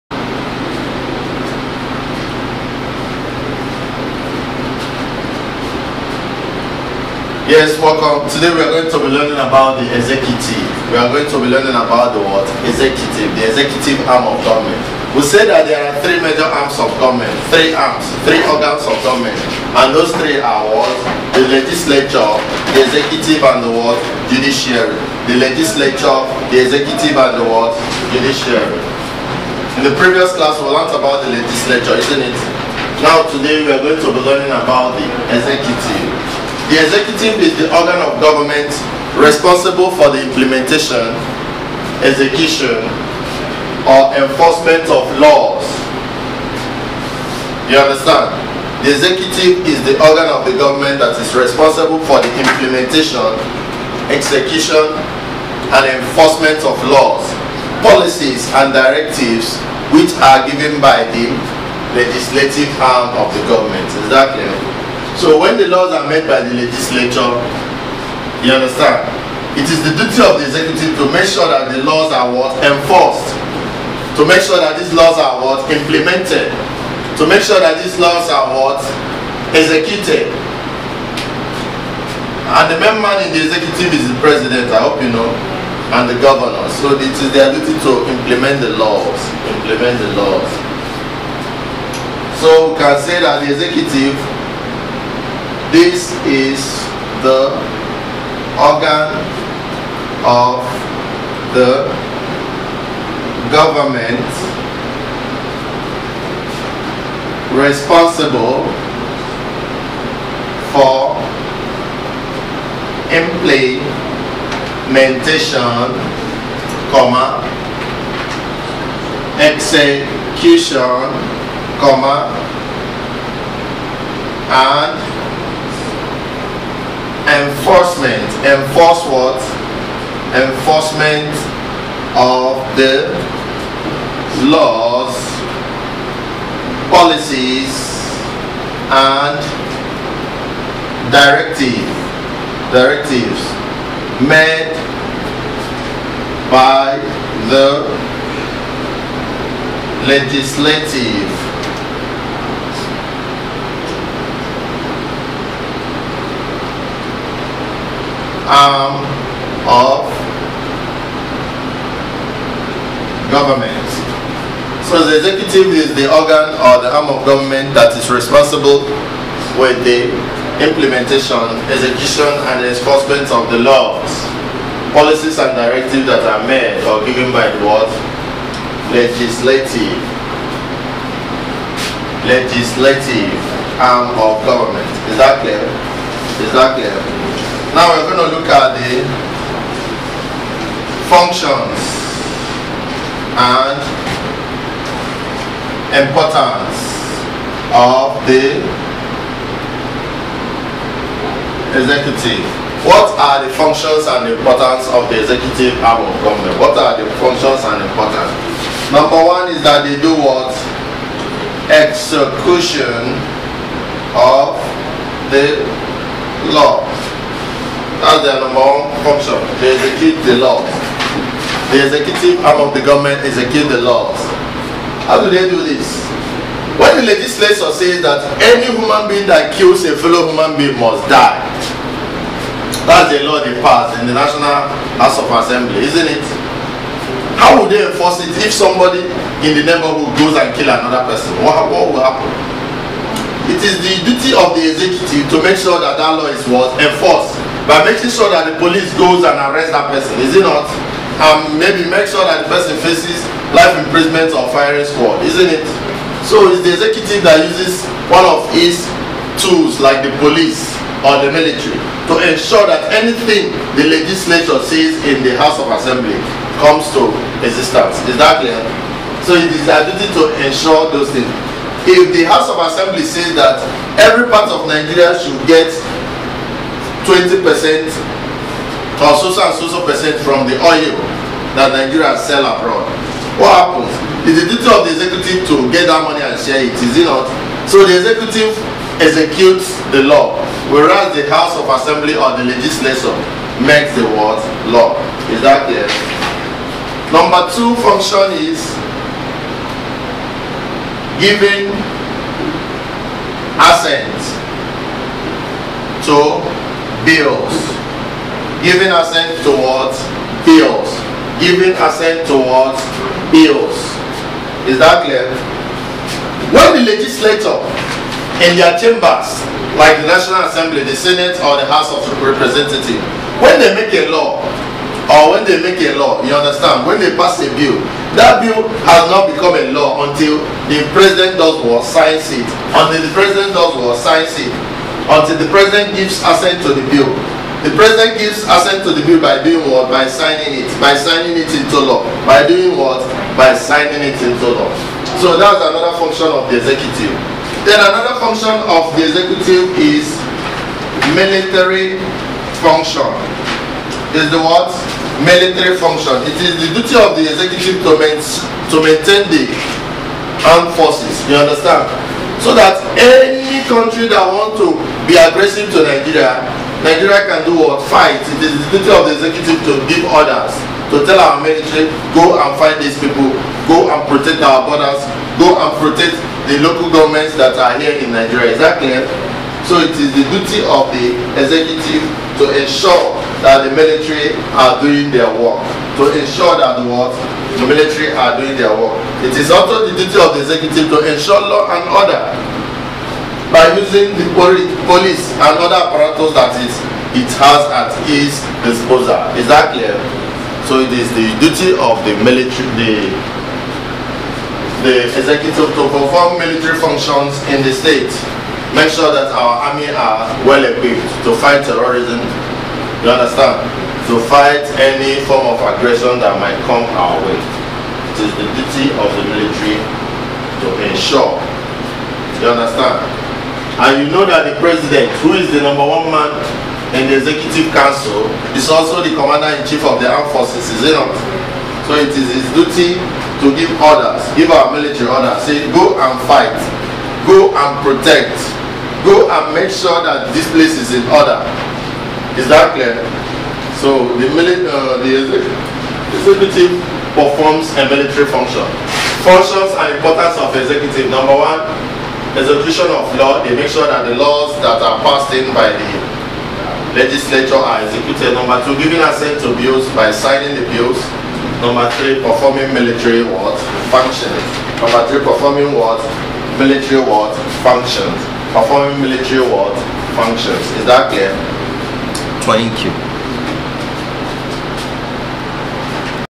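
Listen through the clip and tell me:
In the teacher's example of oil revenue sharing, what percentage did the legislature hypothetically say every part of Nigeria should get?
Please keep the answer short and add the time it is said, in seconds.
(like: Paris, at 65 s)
20 percent, at 277 s.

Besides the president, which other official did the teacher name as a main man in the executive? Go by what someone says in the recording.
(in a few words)
The governor.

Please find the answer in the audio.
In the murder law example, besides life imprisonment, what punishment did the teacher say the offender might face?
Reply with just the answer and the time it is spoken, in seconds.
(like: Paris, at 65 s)
Firing squad, at 254 s.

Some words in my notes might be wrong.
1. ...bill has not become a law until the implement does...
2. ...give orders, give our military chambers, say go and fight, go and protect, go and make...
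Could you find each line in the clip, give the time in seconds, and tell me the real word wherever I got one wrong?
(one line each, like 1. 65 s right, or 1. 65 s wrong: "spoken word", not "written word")
1. 328 s wrong: "president", not "implement"
2. 433 s wrong: "orders", not "chambers".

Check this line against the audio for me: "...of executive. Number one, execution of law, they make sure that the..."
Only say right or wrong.
right.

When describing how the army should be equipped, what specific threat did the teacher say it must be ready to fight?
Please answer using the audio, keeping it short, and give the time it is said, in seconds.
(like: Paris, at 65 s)
Terrorism, at 411 s.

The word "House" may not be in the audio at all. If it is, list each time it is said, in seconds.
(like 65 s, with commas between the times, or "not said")
234 s, 265 s, 272 s, 291 s, 321 s.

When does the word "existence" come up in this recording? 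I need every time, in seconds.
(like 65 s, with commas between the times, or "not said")
267 s.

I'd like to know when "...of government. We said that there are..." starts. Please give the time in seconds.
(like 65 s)
14 s.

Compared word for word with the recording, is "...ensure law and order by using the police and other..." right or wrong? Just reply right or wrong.
right.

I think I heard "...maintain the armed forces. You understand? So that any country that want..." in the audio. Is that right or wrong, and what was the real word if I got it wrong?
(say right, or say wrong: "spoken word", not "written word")
right.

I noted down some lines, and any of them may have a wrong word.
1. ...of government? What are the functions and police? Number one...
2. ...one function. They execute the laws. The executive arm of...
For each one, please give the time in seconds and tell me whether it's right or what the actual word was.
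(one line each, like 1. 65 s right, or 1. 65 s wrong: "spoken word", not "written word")
1. 206 s wrong: "importance", not "police"
2. 218 s right.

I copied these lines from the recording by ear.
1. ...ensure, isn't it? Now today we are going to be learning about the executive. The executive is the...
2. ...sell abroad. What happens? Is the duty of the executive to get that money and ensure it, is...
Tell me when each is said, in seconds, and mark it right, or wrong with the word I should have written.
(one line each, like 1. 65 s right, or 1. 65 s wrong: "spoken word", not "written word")
1. 31 s wrong: "legislature", not "ensure"
2. 282 s wrong: "share", not "ensure".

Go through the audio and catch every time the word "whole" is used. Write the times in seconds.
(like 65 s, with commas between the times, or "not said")
not said.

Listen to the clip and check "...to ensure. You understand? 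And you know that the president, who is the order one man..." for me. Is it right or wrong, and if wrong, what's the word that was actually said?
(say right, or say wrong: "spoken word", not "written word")
wrong: "number", not "order".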